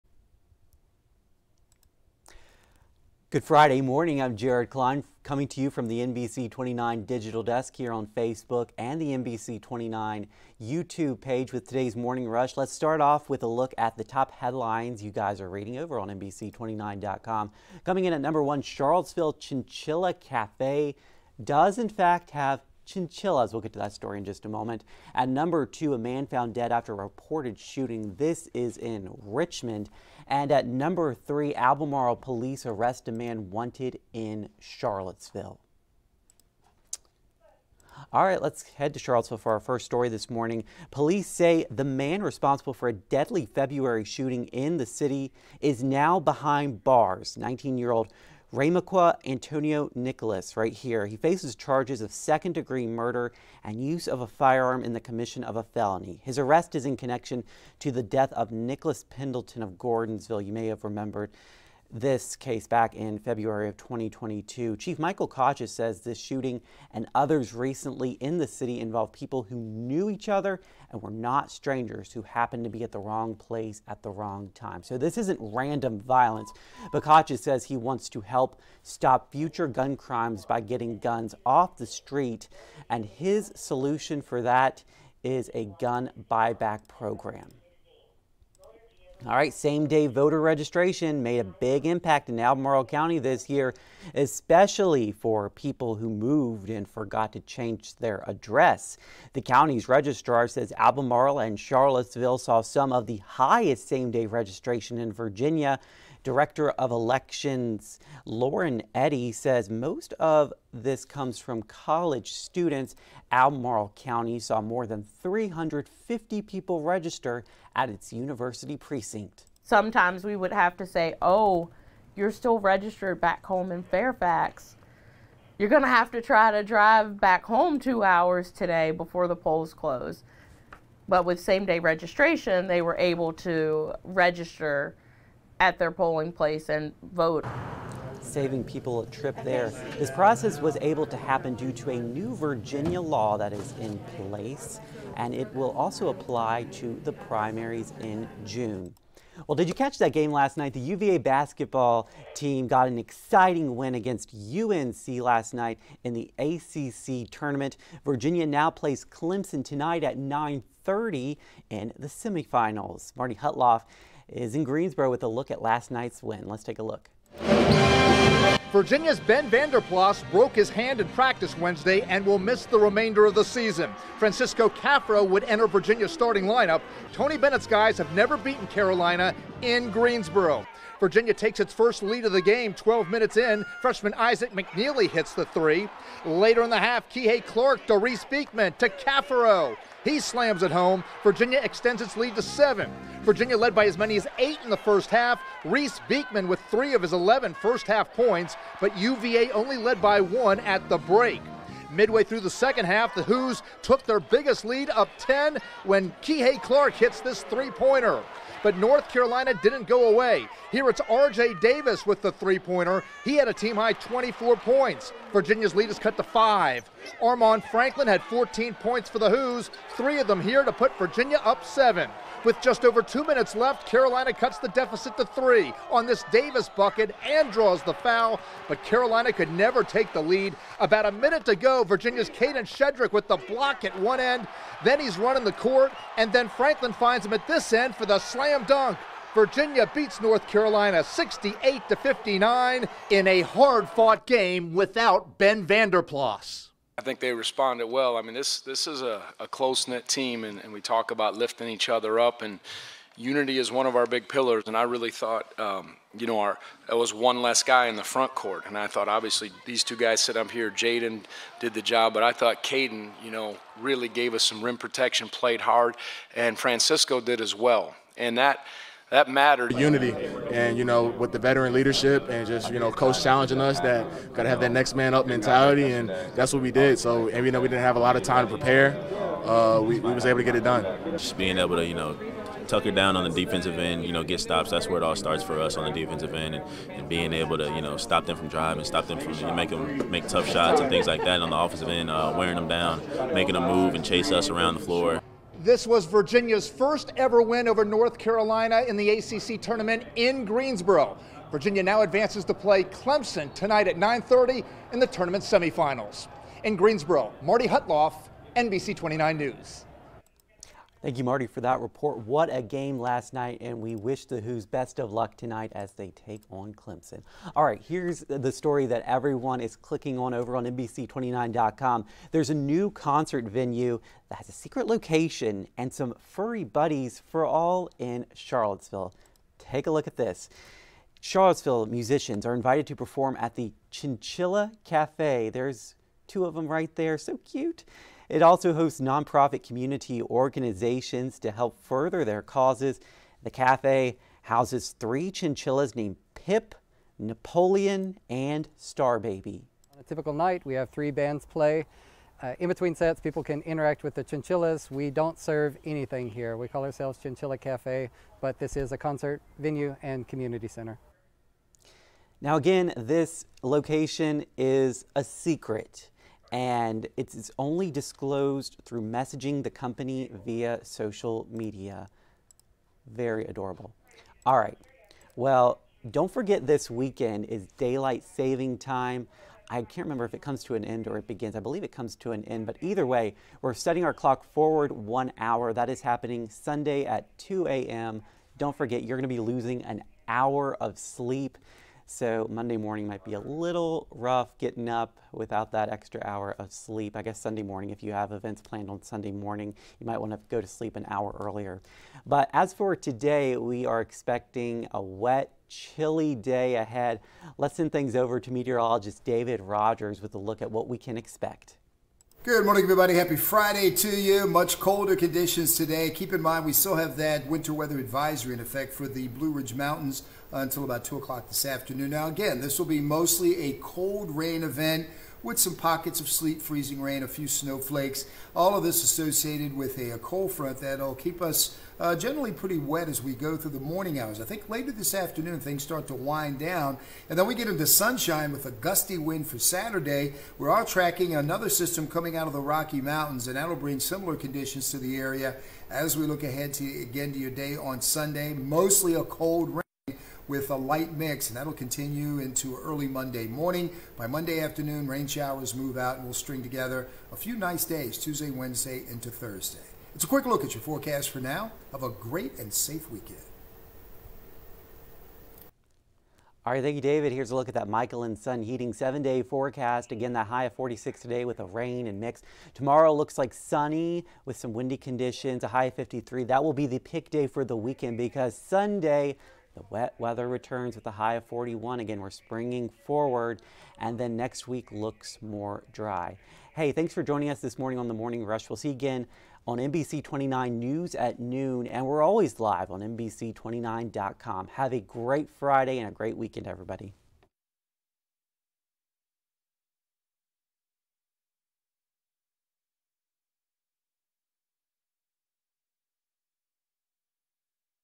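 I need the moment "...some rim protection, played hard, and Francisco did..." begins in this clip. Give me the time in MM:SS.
04:24.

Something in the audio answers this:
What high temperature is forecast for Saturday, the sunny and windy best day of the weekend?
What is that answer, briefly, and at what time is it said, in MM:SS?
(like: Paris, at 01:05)
53, at 07:55.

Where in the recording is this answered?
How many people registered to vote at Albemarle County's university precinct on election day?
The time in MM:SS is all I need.
01:54.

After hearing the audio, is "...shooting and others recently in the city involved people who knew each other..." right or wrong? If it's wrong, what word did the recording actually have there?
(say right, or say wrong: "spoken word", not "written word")
right.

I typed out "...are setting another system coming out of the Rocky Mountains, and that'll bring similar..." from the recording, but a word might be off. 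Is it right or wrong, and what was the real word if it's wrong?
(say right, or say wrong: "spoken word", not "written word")
wrong: "tracking", not "setting".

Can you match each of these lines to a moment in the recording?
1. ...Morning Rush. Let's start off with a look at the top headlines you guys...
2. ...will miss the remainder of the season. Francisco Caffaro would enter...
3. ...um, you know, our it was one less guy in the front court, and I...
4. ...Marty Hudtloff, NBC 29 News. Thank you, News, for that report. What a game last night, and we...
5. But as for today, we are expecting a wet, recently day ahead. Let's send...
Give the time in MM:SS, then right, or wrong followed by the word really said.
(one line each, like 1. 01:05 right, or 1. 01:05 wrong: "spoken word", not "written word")
1. 00:11 right
2. 02:52 right
3. 04:15 right
4. 05:07 wrong: "Marty", not "News"
5. 06:42 wrong: "chilly", not "recently".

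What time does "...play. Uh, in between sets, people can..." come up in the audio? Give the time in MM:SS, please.
05:51.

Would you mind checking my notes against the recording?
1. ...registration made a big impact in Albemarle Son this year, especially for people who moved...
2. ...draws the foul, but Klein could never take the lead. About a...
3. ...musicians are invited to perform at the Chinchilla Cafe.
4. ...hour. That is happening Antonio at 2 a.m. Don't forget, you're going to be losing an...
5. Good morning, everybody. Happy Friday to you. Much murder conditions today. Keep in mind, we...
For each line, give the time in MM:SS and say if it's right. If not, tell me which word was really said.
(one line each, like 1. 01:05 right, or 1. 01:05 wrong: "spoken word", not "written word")
1. 01:30 wrong: "County", not "Son"
2. 03:47 wrong: "Carolina", not "Klein"
3. 05:31 right
4. 06:25 wrong: "Sunday", not "Antonio"
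5. 06:52 wrong: "colder", not "murder".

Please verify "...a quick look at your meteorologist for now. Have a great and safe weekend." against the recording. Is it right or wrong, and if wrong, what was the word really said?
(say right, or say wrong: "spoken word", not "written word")
wrong: "forecast", not "meteorologist".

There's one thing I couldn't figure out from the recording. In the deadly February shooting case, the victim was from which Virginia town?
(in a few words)
Gordonsville.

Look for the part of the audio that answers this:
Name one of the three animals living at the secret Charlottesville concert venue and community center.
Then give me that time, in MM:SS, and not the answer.
05:47.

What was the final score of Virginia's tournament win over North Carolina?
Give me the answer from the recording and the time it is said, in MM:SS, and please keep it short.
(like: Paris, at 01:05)
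68 to 59, at 04:01.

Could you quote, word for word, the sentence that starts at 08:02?
Again, we're springing forward, and then next week looks more dry.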